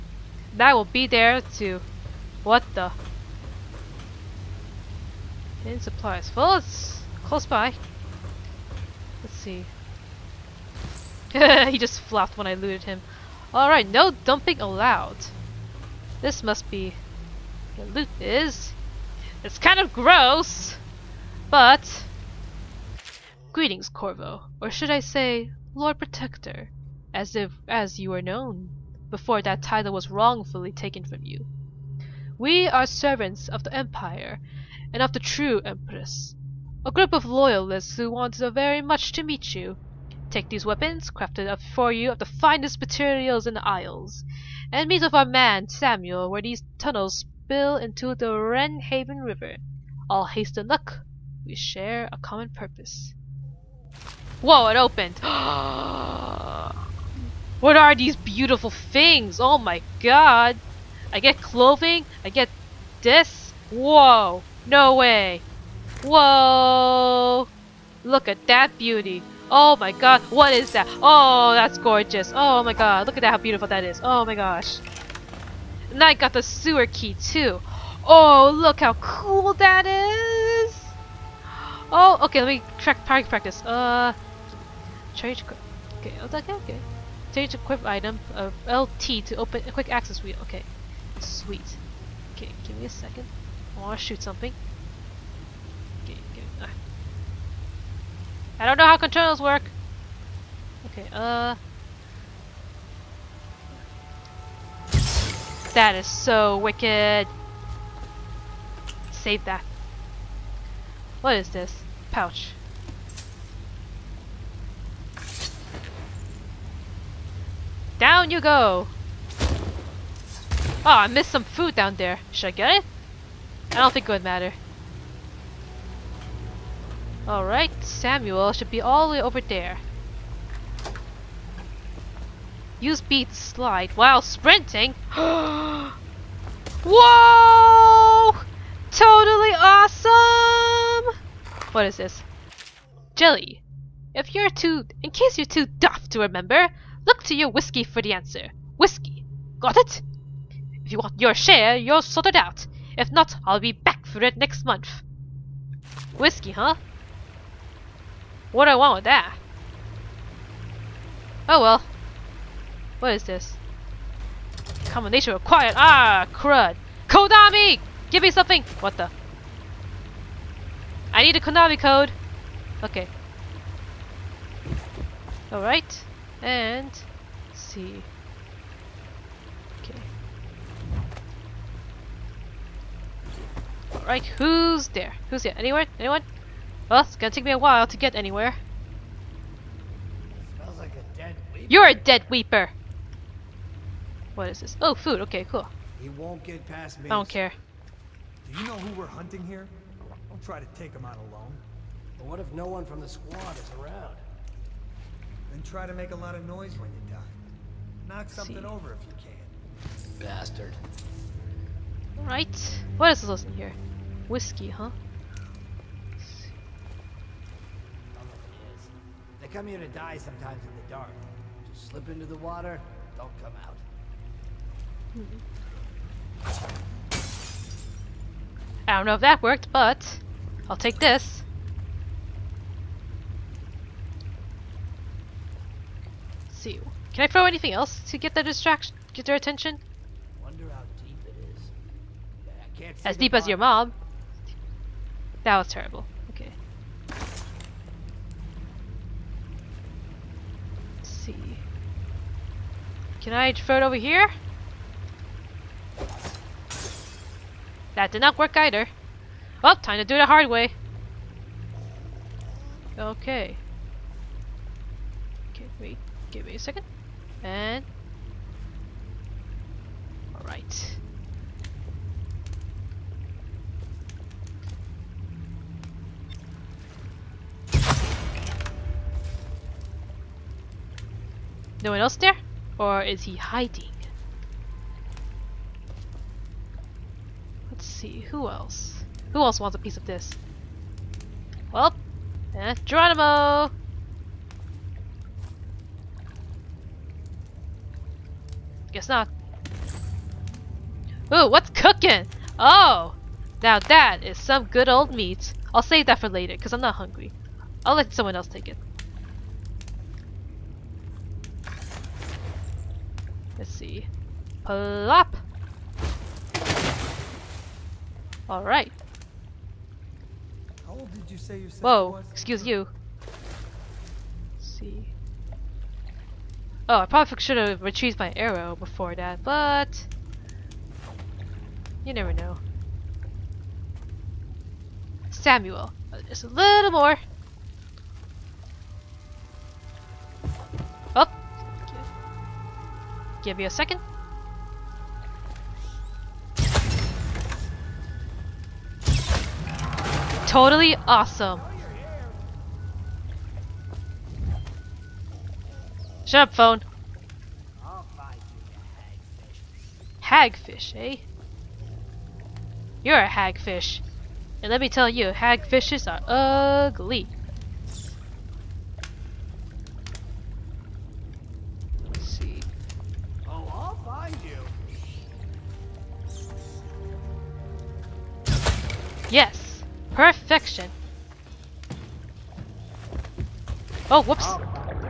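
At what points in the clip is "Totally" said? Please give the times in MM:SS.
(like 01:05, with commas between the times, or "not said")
02:18, 05:50.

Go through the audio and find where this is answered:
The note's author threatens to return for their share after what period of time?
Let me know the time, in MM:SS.
02:34.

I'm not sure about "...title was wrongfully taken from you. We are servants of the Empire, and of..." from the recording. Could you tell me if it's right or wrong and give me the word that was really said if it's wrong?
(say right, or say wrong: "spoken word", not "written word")
right.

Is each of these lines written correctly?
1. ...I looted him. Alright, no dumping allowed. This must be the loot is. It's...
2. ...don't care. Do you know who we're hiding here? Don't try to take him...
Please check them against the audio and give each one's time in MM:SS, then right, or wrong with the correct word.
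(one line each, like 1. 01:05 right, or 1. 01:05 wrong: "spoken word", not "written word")
1. 00:12 right
2. 03:17 wrong: "hunting", not "hiding".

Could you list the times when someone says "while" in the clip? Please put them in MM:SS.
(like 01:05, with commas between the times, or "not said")
02:13, 03:07.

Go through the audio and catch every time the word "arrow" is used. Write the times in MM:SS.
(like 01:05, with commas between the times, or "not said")
05:28.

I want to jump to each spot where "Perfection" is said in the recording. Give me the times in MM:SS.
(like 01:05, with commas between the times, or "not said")
06:20.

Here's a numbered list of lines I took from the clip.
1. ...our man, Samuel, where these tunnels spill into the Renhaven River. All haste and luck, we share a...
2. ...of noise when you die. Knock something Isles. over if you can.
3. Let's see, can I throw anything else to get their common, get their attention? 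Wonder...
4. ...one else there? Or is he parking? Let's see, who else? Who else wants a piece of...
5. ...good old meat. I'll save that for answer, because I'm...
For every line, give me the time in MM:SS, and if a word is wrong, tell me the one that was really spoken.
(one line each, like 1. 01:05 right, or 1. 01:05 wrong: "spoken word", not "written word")
1. 00:45 right
2. 03:26 wrong: "See", not "Isles"
3. 03:56 wrong: "distraction", not "common"
4. 04:41 wrong: "hiding", not "parking"
5. 05:04 wrong: "later", not "answer".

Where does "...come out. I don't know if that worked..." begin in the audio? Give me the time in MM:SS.
03:43.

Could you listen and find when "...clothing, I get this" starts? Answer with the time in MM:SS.
01:01.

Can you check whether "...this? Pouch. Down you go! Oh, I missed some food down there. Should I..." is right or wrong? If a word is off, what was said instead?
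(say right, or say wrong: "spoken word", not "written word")
right.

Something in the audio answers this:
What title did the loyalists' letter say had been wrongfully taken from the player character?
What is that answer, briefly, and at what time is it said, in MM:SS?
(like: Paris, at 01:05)
Lord Protector, at 00:25.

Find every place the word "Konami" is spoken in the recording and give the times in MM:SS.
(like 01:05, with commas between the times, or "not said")
02:47, 02:51.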